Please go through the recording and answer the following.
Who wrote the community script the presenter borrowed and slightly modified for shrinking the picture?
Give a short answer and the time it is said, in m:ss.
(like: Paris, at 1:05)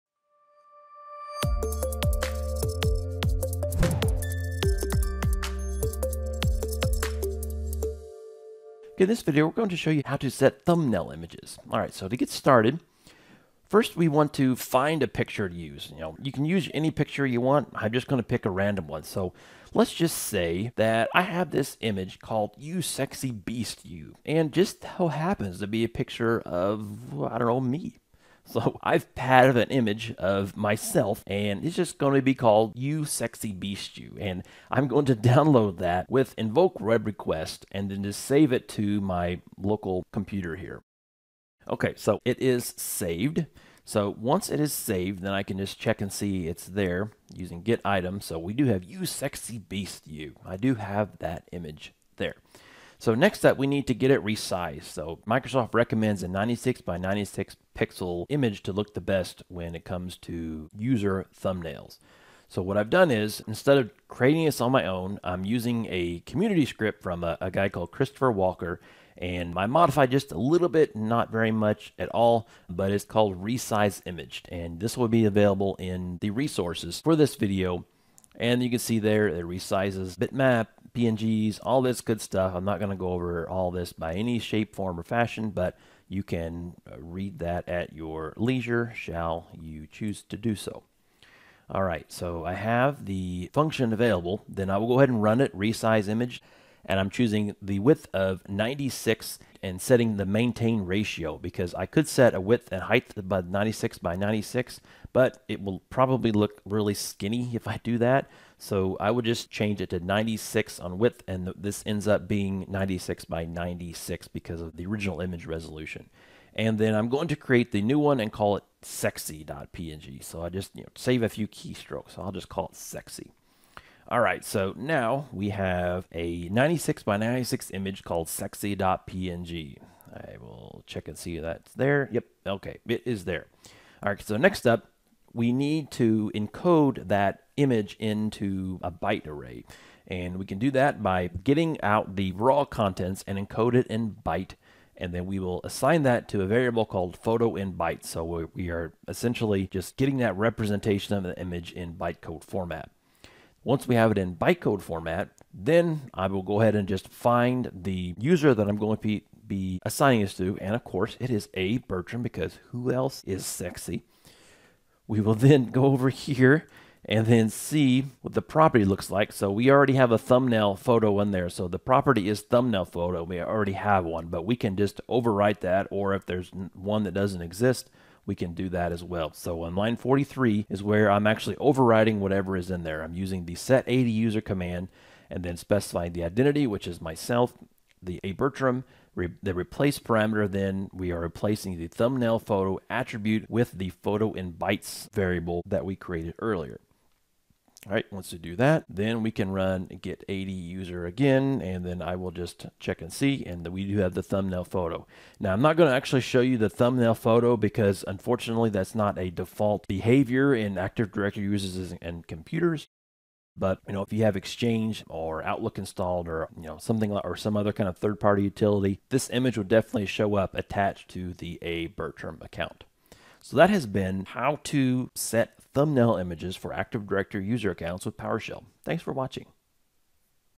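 Christopher Walker, at 1:07.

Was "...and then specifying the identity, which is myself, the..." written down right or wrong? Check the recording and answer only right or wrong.
right.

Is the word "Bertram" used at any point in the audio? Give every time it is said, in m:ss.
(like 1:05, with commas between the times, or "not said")
2:41, 3:08, 3:41.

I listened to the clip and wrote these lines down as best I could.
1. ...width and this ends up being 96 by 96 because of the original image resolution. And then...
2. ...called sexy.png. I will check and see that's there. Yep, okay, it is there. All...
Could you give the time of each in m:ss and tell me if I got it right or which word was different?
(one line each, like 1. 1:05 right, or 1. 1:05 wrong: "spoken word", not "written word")
1. 1:50 right
2. 2:08 right.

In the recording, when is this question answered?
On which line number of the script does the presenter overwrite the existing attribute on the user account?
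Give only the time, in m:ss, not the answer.
2:59.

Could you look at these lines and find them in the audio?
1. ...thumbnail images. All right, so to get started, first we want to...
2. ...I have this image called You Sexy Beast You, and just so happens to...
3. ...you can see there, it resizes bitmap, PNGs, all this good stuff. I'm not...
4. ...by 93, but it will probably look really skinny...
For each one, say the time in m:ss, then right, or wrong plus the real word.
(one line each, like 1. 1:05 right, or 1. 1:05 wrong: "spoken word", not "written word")
1. 0:10 right
2. 0:21 right
3. 1:18 right
4. 1:43 wrong: "96", not "93".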